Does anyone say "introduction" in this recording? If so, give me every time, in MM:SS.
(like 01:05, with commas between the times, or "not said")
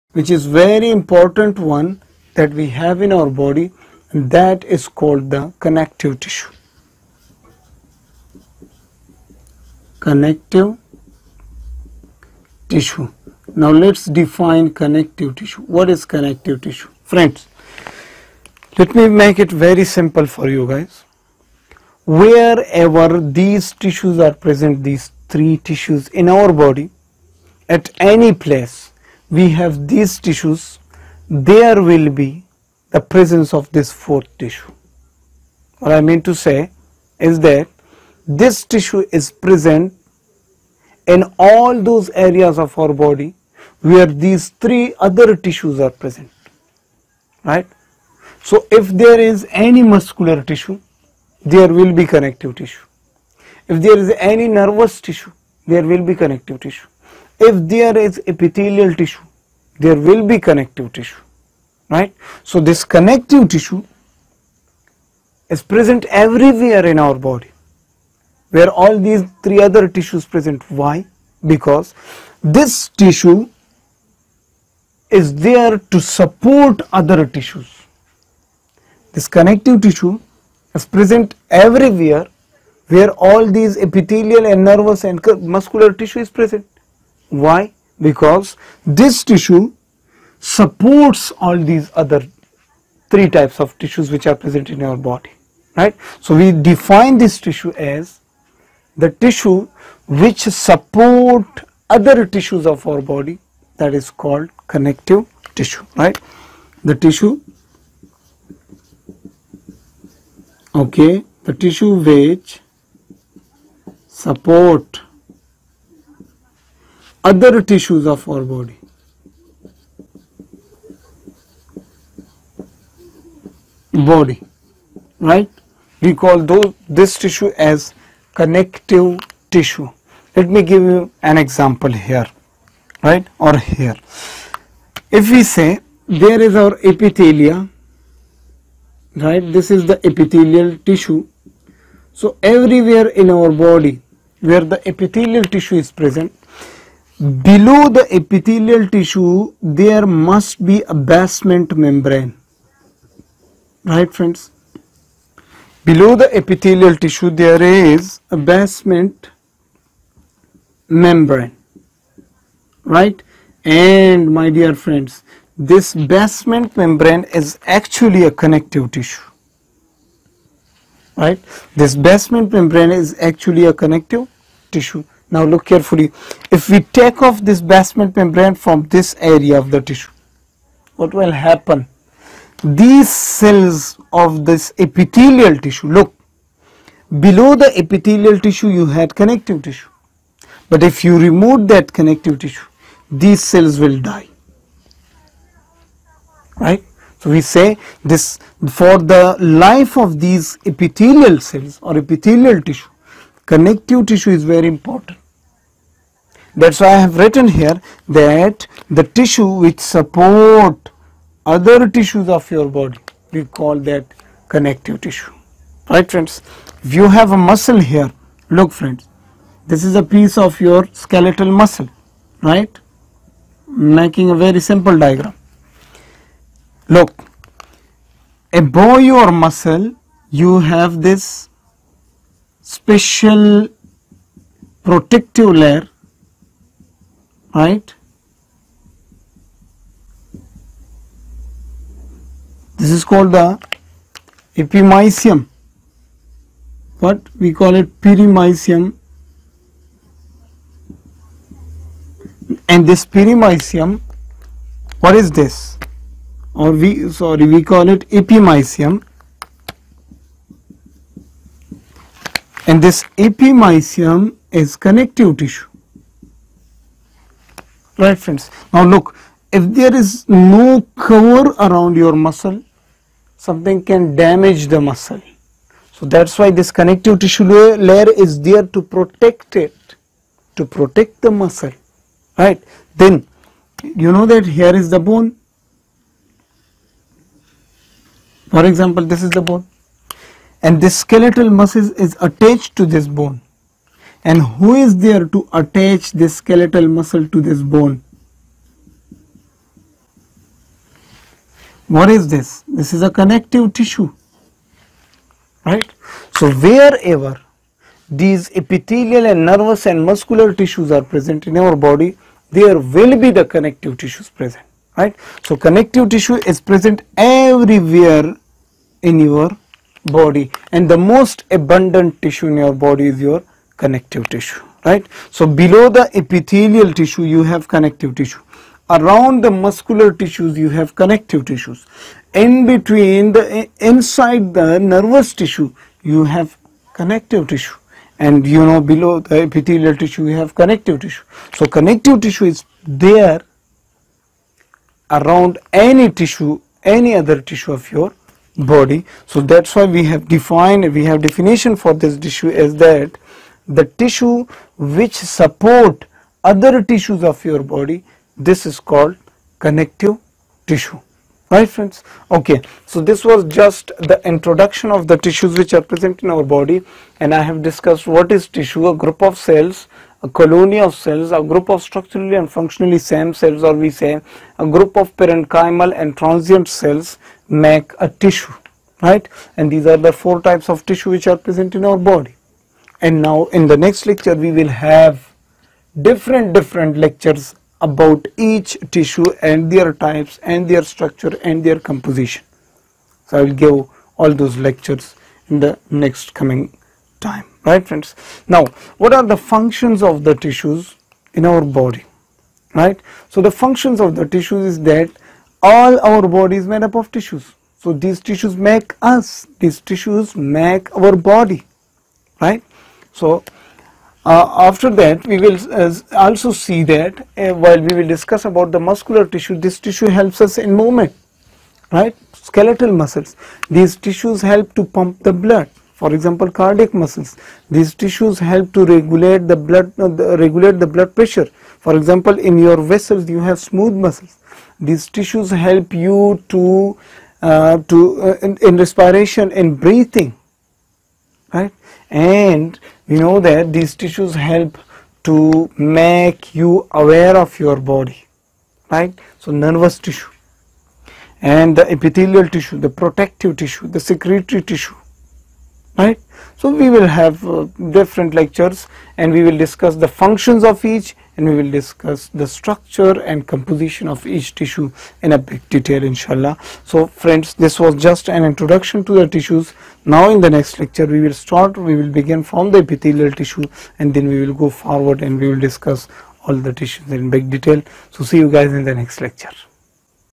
06:04, 07:48.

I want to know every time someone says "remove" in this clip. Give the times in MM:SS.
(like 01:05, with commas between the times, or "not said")
03:11.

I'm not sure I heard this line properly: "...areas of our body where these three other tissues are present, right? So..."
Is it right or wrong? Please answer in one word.
right.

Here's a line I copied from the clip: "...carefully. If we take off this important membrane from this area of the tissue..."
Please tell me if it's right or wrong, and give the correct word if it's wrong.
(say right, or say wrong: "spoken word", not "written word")
wrong: "basement", not "important".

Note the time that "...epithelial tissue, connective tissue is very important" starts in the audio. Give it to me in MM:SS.
03:21.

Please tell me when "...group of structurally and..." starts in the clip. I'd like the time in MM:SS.
06:11.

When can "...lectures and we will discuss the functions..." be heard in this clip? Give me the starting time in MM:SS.
07:38.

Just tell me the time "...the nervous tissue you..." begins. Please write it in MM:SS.
05:34.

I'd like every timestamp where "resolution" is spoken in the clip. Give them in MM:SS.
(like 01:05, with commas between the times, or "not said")
not said.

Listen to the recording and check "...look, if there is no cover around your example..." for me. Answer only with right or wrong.
wrong.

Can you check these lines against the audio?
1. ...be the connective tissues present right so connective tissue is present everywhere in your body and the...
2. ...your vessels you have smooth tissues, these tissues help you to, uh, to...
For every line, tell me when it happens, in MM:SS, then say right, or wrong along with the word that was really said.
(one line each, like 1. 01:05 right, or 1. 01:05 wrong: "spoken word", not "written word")
1. 05:13 right
2. 07:12 wrong: "muscles", not "tissues".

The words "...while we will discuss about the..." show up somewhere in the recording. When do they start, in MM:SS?
06:57.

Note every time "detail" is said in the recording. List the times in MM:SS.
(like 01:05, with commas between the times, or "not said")
07:45, 07:57.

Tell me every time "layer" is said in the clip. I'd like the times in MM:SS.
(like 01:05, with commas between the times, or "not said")
03:55, 04:37.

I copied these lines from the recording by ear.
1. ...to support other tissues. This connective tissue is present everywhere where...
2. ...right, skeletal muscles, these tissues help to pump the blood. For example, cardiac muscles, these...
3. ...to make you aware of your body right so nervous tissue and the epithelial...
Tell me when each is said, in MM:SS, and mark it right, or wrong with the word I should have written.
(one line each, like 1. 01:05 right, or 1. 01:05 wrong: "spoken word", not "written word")
1. 01:15 right
2. 07:01 right
3. 07:25 right.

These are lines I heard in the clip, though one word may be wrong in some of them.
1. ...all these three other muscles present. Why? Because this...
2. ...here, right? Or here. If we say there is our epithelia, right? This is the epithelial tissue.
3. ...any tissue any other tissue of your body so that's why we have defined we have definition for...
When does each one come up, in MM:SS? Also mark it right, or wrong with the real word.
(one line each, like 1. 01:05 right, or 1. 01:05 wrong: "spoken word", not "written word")
1. 01:08 wrong: "tissues", not "muscles"
2. 02:11 right
3. 05:45 right.